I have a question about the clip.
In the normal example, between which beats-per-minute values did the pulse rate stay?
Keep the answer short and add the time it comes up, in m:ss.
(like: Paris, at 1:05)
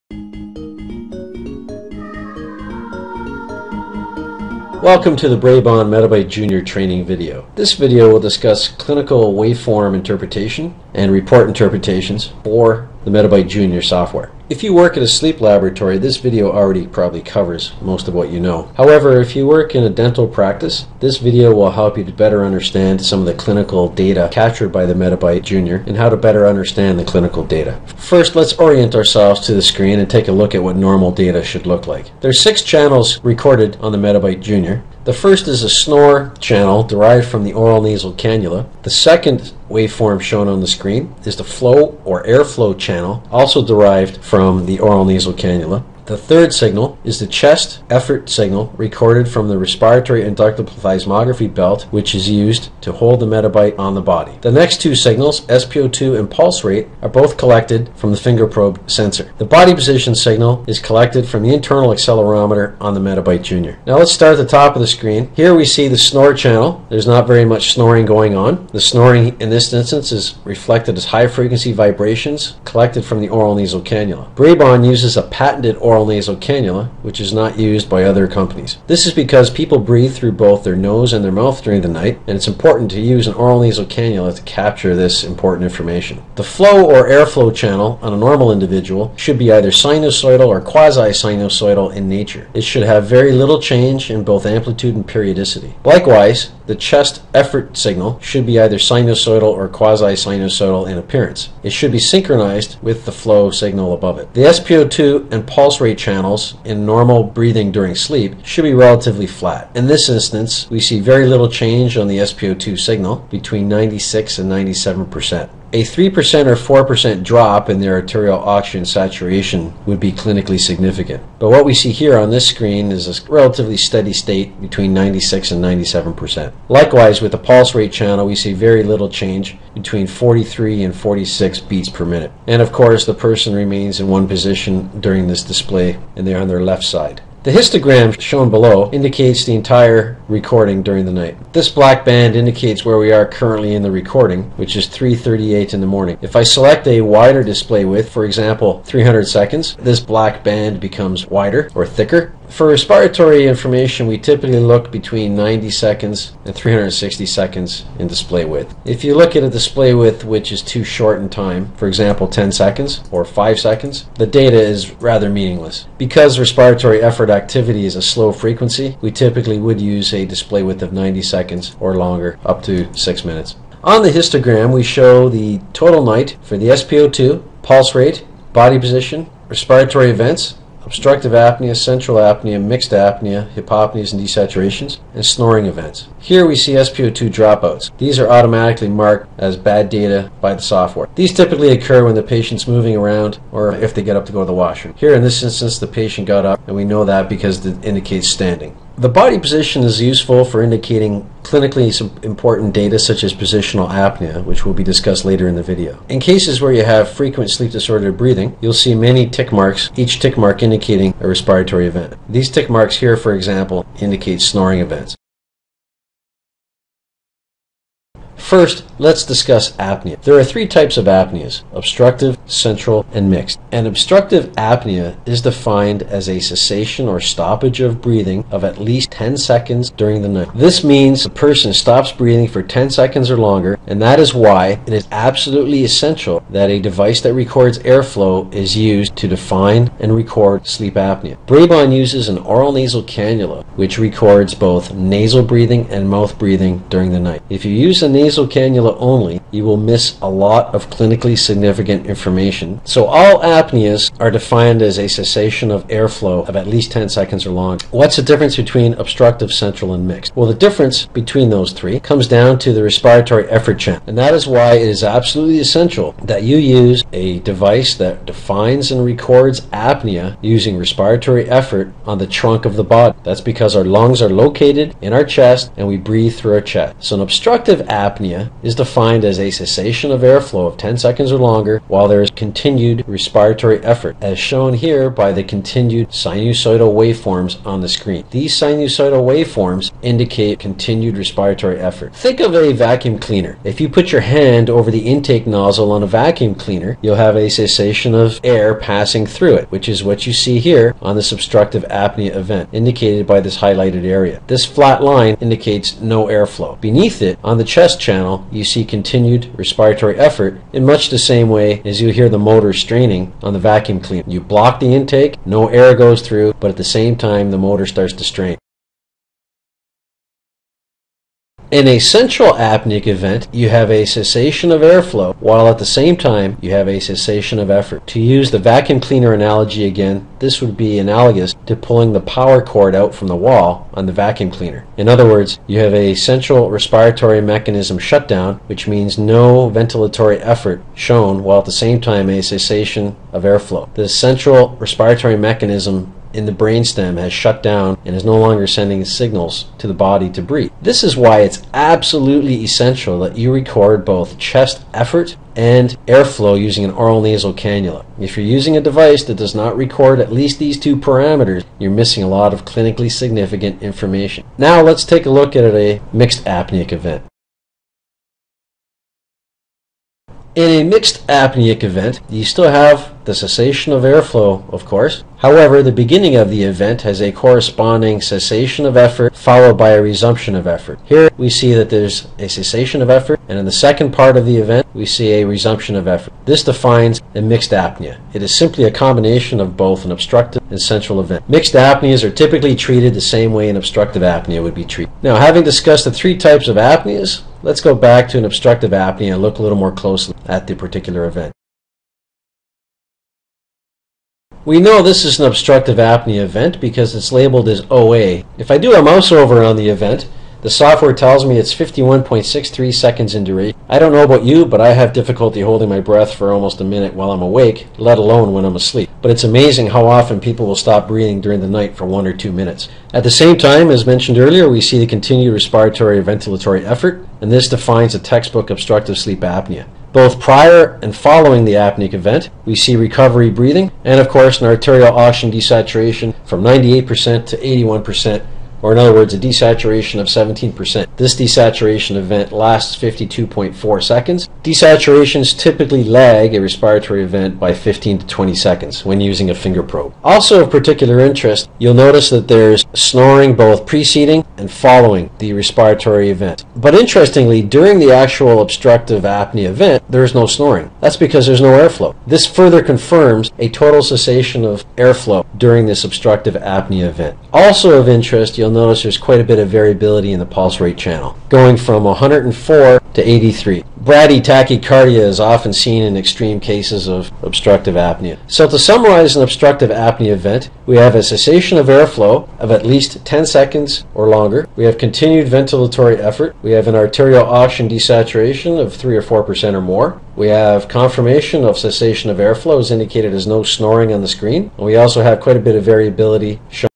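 43 and 46, at 2:09.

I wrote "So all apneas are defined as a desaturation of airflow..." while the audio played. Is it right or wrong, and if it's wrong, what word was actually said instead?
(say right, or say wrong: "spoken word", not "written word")
wrong: "cessation", not "desaturation".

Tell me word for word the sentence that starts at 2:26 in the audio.
If I select a wider display width, for example 300 seconds, this black band becomes wider or thicker.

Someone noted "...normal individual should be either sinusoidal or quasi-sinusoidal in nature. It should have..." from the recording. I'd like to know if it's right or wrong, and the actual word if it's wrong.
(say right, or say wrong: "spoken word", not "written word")
right.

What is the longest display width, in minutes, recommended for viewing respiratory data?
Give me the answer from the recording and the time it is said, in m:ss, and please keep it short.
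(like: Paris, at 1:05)
6 minutes, at 2:52.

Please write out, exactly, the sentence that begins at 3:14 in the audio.
Here in this instance the patient got up and we know that because it indicates standing.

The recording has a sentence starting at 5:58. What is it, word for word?
If you're using a device that does not record at least these two parameters, you're missing a lot of clinically significant information.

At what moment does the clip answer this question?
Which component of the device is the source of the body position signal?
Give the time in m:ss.
1:01.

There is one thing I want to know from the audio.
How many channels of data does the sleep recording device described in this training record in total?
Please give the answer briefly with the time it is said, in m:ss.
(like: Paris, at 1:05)
6, at 0:32.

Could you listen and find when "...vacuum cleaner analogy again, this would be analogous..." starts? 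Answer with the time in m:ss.
5:28.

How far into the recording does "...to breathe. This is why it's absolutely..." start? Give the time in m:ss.
5:50.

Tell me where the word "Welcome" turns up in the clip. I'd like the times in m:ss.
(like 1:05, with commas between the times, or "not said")
0:04.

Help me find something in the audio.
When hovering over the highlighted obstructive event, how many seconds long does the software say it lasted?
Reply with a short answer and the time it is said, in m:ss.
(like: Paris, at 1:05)
51.63 seconds, at 6:51.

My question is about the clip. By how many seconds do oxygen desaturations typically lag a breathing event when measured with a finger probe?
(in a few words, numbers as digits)
15 to 20 seconds.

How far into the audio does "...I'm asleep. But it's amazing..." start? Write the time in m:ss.
6:58.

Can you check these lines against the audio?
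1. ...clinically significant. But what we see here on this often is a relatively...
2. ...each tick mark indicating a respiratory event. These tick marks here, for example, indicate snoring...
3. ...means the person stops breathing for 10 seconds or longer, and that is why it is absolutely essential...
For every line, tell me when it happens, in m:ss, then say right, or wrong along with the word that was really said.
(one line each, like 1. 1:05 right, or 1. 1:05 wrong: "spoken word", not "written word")
1. 2:00 wrong: "screen", not "often"
2. 3:29 right
3. 3:50 right.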